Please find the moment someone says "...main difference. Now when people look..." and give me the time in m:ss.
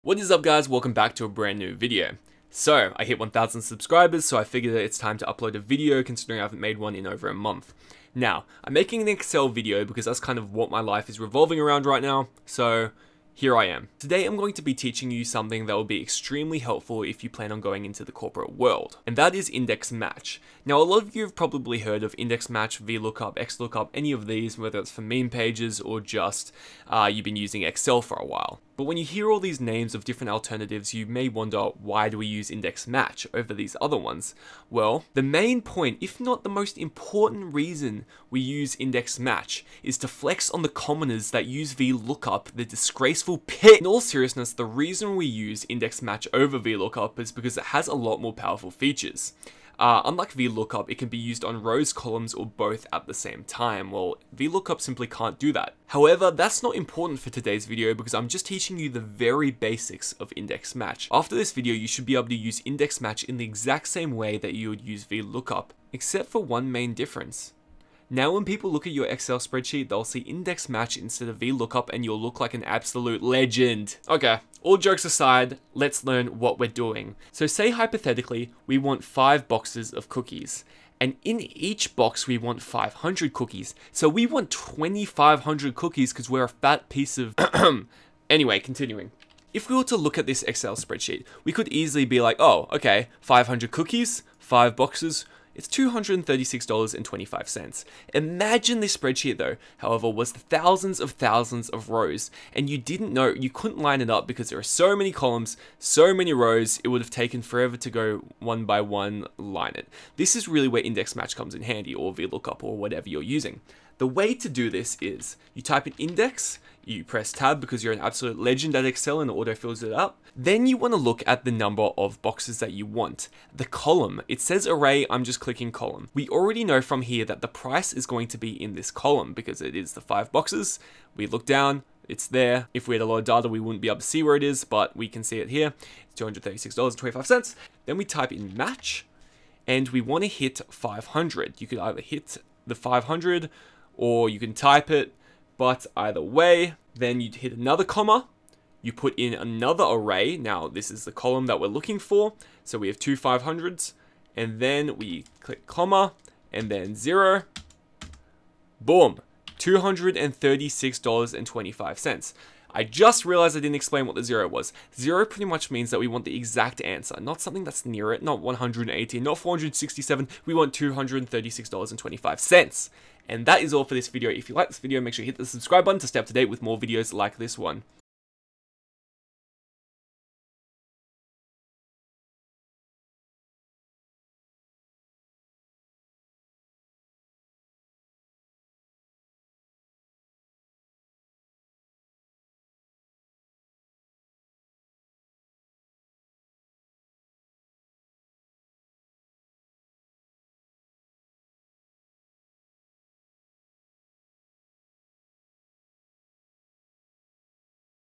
1:06.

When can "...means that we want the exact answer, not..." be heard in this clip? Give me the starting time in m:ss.
2:45.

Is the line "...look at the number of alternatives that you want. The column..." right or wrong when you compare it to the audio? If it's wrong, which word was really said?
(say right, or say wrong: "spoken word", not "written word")
wrong: "boxes", not "alternatives".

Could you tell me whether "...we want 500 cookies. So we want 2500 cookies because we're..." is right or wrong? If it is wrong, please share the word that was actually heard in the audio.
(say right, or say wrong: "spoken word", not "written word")
right.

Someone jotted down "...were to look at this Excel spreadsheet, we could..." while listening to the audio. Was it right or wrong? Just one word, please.
right.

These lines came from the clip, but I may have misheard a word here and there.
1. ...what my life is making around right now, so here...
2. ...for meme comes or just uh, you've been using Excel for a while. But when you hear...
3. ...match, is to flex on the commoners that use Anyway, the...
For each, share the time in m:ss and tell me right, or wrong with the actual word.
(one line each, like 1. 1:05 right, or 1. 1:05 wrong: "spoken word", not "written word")
1. 0:10 wrong: "revolving", not "making"
2. 0:24 wrong: "pages", not "comes"
3. 0:39 wrong: "VLOOKUP", not "Anyway".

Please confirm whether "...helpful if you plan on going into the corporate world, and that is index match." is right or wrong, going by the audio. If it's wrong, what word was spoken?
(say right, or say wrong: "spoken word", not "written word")
right.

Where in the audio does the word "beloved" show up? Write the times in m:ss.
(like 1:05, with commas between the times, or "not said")
not said.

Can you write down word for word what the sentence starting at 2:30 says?
Now, this is the column that we're looking for.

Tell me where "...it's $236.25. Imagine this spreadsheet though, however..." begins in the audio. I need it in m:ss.
1:35.